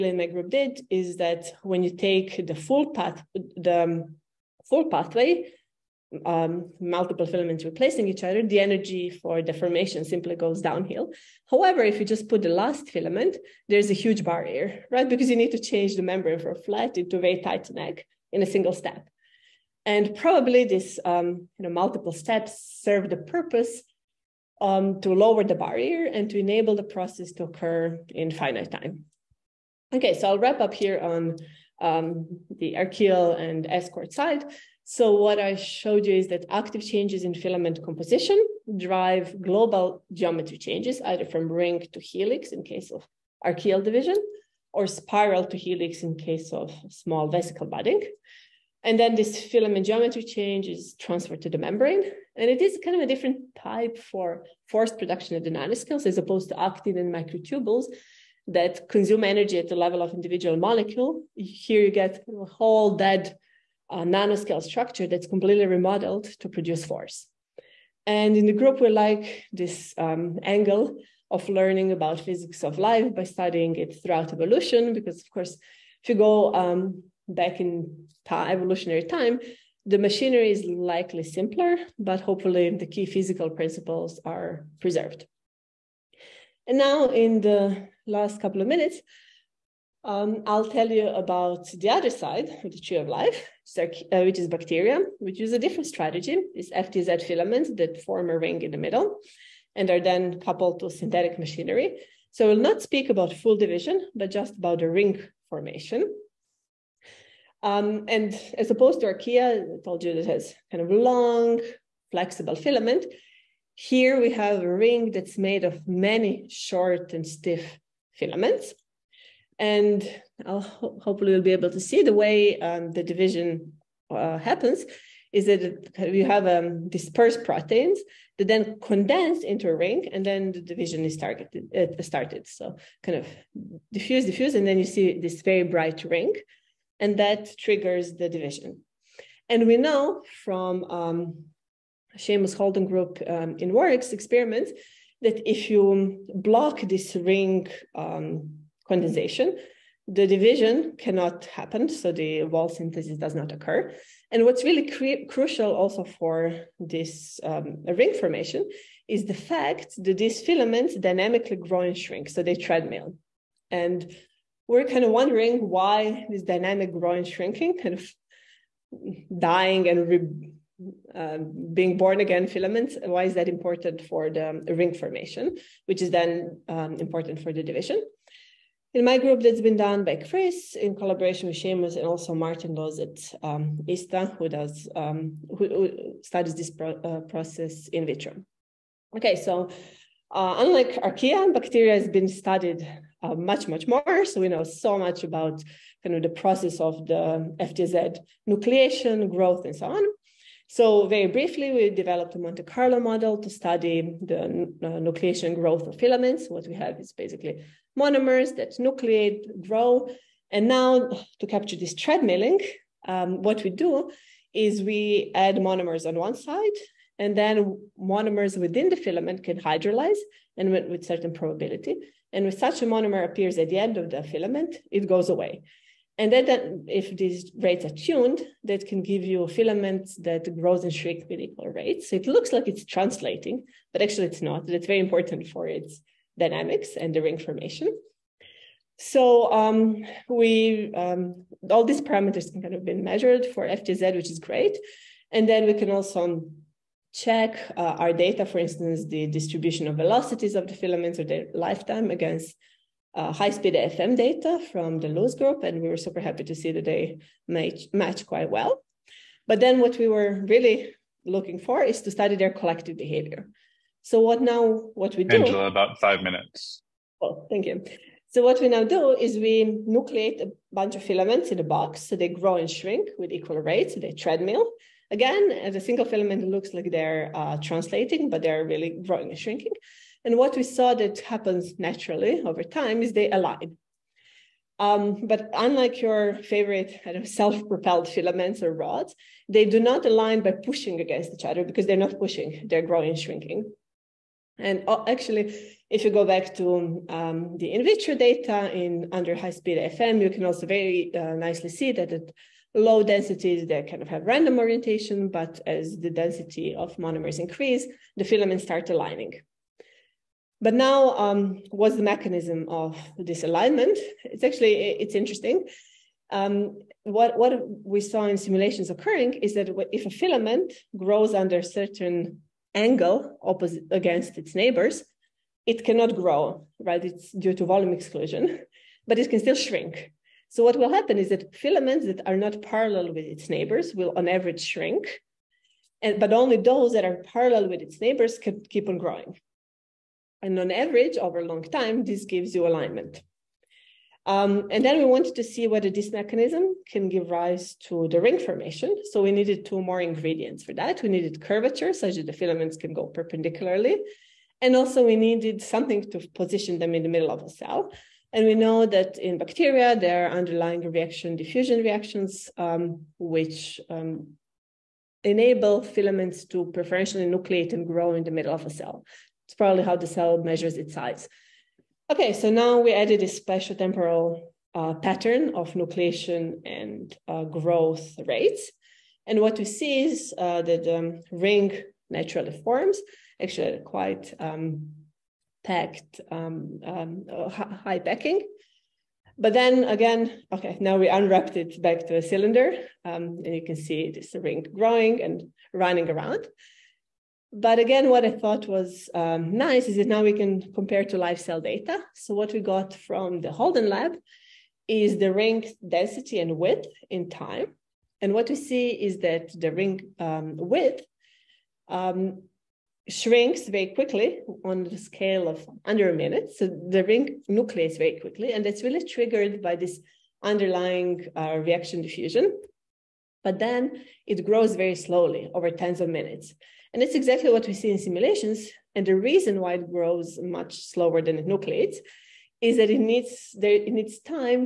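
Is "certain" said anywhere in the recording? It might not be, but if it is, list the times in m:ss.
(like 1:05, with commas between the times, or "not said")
3:41, 5:21.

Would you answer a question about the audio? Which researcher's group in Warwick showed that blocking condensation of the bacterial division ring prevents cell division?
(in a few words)
Seamus Holden.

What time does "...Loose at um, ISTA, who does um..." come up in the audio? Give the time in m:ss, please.
3:02.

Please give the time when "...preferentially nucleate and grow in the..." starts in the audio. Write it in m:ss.
6:06.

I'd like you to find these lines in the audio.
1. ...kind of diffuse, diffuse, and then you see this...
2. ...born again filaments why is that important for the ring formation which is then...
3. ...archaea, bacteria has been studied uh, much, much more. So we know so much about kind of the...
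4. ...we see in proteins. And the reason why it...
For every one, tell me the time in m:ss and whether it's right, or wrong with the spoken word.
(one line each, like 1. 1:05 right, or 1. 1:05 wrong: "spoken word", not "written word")
1. 2:13 right
2. 2:51 right
3. 3:11 right
4. 7:07 wrong: "simulations", not "proteins".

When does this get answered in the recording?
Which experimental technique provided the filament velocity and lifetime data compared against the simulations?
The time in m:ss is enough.
4:13.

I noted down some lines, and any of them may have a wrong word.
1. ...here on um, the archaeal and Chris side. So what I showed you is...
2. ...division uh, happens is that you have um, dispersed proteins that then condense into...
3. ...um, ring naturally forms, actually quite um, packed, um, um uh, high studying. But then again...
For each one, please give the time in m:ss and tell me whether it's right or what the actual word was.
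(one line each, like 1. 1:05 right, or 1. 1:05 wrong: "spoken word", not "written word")
1. 0:30 wrong: "ESCRT", not "Chris"
2. 2:03 right
3. 6:20 wrong: "packing", not "studying".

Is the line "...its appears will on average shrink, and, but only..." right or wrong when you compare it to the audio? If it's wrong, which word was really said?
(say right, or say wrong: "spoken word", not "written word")
wrong: "neighbors", not "appears".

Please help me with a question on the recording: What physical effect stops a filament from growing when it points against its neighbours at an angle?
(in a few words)
volume exclusion.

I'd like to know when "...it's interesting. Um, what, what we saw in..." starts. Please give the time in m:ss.
5:14.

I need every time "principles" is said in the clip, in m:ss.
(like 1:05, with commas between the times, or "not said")
1:23.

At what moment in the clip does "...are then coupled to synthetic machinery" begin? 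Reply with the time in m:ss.
1:39.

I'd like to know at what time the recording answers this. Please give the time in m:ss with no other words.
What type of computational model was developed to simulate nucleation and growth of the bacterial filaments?
3:22.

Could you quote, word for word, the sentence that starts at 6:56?
So the ring nucleates very quickly, and that's really triggered by this underlying uh, reaction diffusion.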